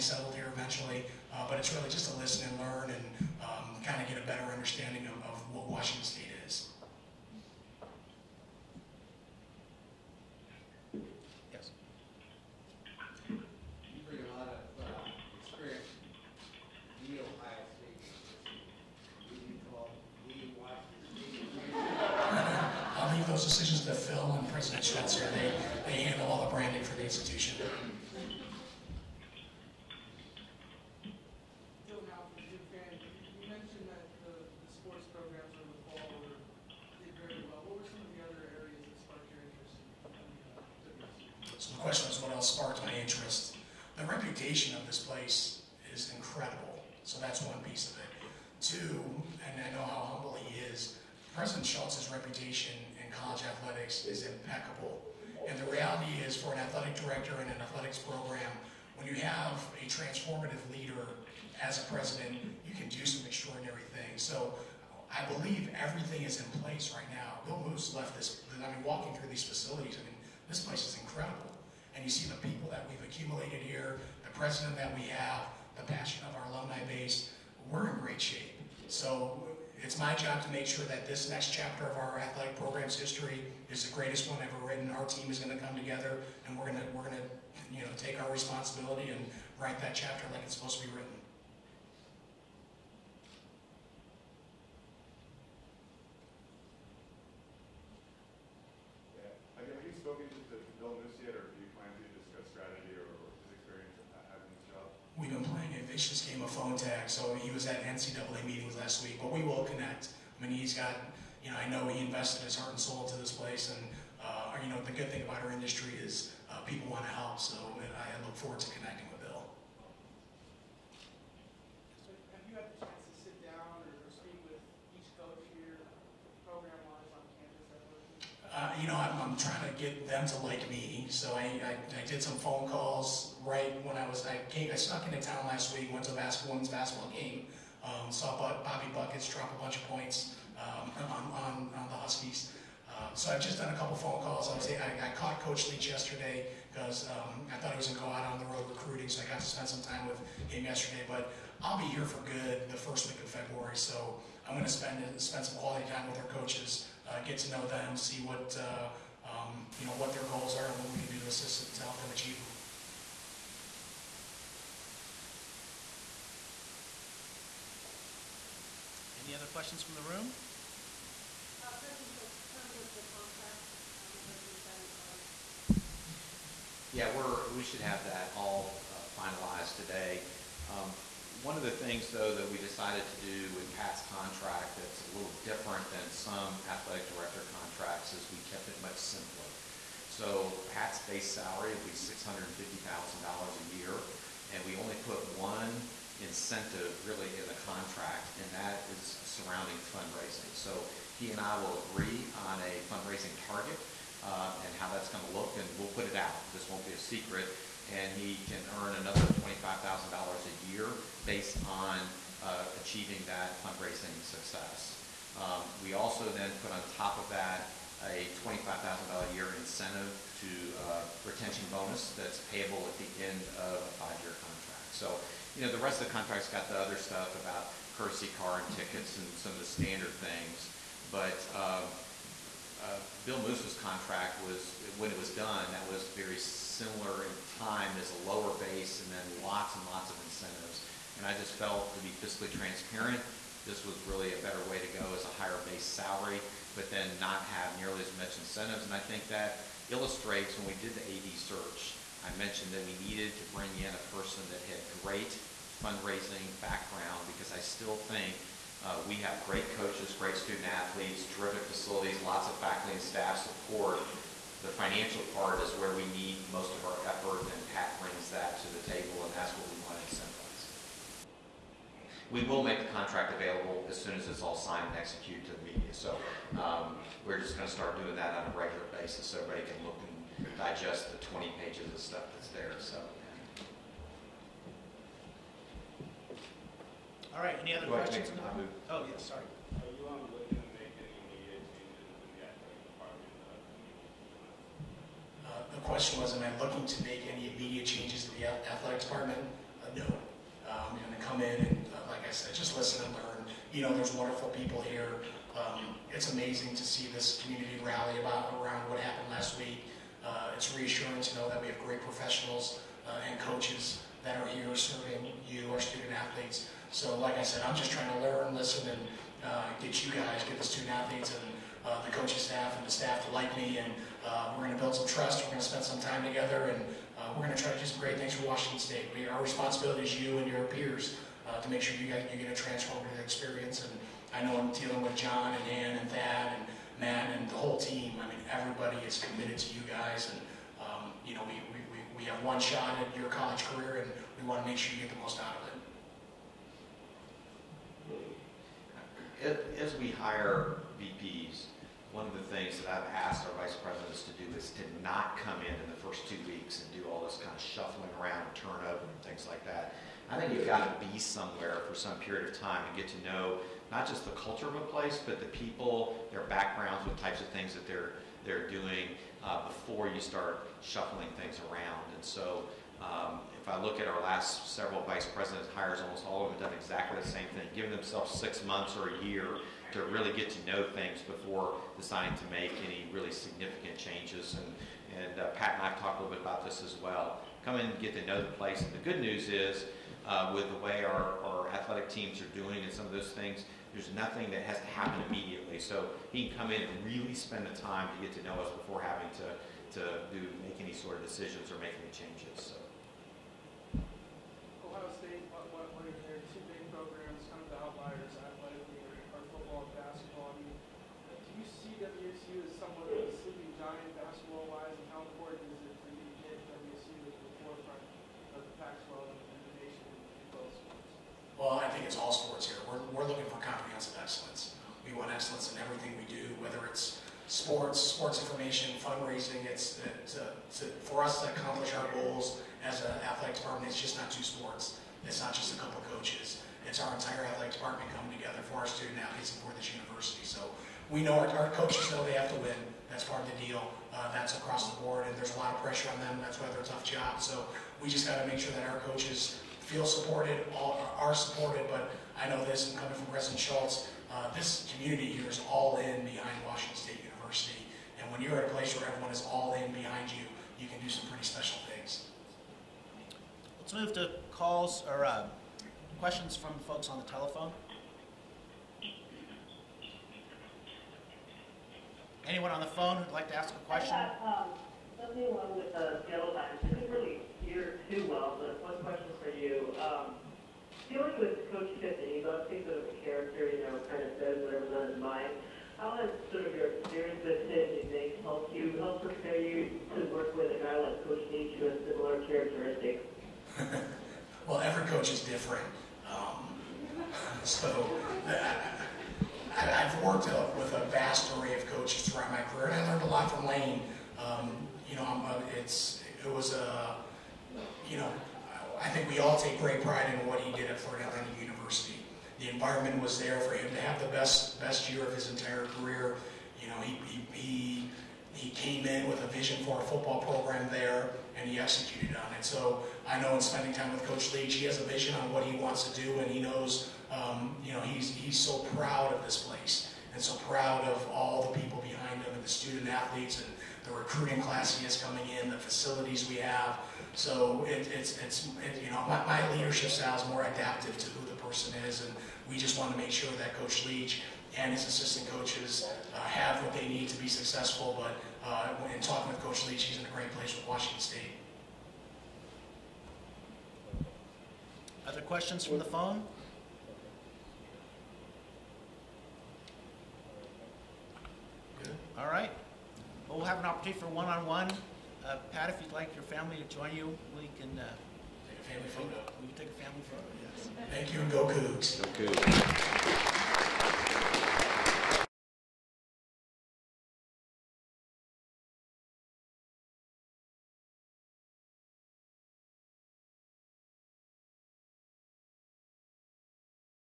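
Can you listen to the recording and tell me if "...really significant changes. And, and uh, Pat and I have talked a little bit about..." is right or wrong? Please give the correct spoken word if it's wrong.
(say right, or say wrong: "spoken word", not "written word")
right.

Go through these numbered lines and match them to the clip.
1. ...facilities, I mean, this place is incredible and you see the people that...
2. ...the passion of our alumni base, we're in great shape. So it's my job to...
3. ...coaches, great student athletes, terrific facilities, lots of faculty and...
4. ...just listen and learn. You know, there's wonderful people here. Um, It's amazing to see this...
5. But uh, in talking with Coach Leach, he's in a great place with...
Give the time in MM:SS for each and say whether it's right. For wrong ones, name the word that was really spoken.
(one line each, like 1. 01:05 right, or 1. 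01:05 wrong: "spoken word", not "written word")
1. 01:09 right
2. 01:15 right
3. 04:19 right
4. 05:02 right
5. 09:08 right.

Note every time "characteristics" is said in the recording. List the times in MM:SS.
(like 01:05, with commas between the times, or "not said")
08:12.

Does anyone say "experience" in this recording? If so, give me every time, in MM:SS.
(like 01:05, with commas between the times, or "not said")
05:33, 08:06.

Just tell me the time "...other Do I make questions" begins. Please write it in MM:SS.
04:47.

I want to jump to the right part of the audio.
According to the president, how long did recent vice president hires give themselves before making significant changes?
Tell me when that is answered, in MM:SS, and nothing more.
06:18.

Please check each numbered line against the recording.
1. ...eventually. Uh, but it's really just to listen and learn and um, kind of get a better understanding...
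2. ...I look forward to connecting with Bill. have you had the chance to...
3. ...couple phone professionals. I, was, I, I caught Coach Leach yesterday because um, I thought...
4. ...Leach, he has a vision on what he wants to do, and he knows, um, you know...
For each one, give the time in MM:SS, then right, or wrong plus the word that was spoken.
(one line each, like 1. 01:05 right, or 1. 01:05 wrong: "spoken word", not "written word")
1. 00:00 right
2. 01:57 right
3. 02:23 wrong: "calls", not "professionals"
4. 08:44 right.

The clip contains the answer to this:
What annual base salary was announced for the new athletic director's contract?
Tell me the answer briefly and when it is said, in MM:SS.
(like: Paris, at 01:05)
$650,000, at 03:11.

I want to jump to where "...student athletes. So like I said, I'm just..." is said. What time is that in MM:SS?
05:15.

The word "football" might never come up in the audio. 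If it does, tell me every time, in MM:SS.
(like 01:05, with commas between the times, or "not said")
08:40.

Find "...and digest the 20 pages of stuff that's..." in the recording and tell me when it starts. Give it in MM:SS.
04:40.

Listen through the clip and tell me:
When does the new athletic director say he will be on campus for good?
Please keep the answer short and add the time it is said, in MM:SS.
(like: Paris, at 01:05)
first week of February, at 02:32.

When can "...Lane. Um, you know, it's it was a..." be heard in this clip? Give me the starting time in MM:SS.
08:23.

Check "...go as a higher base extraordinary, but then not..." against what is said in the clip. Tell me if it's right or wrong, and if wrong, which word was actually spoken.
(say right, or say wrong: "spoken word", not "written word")
wrong: "salary", not "extraordinary".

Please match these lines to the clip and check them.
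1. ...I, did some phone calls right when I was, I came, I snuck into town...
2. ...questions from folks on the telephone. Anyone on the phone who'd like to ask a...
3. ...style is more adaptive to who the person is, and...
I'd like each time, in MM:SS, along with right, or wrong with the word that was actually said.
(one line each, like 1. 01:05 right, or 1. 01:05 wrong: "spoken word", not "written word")
1. 02:11 right
2. 07:46 right
3. 09:00 right.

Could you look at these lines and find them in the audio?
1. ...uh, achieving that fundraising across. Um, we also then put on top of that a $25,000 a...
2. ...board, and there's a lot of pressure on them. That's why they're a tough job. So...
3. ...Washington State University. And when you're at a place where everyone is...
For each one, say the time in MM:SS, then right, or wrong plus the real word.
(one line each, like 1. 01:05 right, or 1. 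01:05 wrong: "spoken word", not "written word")
1. 03:32 wrong: "success", not "across"
2. 07:25 right
3. 07:36 right.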